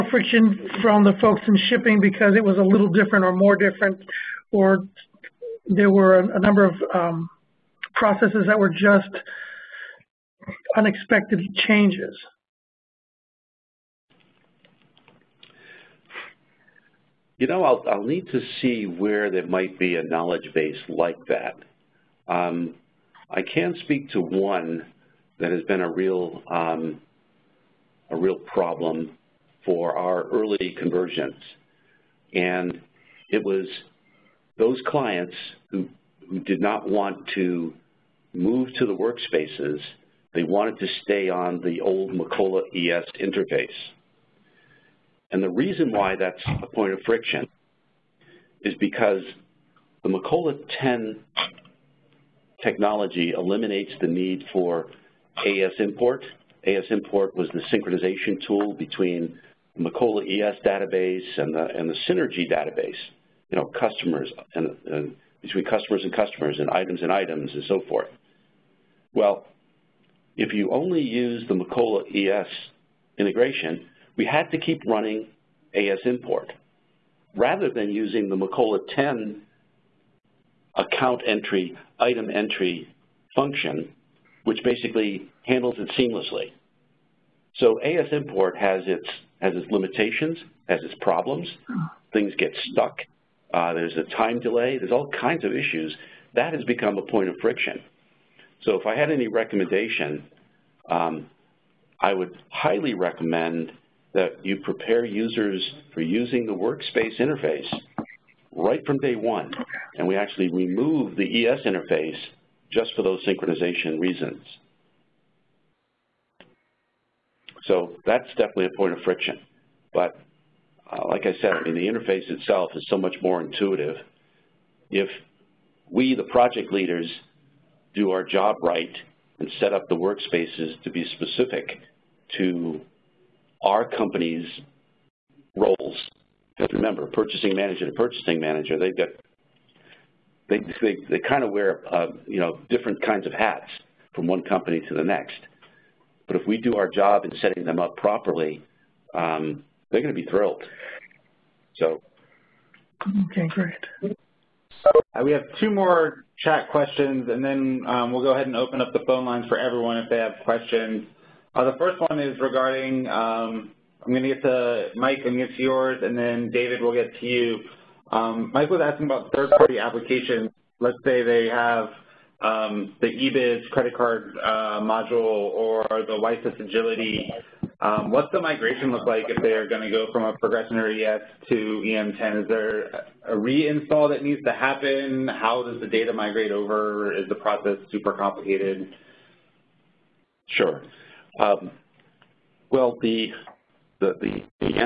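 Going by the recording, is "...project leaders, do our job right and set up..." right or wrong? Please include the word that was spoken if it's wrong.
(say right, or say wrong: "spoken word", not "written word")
right.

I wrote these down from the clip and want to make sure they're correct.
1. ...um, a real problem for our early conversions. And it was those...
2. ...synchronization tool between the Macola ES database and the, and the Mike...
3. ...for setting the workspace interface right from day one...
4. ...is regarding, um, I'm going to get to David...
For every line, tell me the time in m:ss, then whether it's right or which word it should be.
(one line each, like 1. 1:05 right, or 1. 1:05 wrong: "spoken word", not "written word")
1. 0:26 right
2. 0:57 wrong: "Synergy", not "Mike"
3. 1:45 wrong: "using", not "setting"
4. 2:42 wrong: "Mike", not "David".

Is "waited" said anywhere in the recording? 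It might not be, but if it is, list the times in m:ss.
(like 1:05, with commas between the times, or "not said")
not said.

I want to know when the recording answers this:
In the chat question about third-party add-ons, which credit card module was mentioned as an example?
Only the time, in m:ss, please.
2:53.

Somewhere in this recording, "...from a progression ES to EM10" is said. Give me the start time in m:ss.
3:00.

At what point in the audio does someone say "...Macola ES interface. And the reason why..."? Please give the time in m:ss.
0:42.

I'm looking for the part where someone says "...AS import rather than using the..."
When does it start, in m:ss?
1:15.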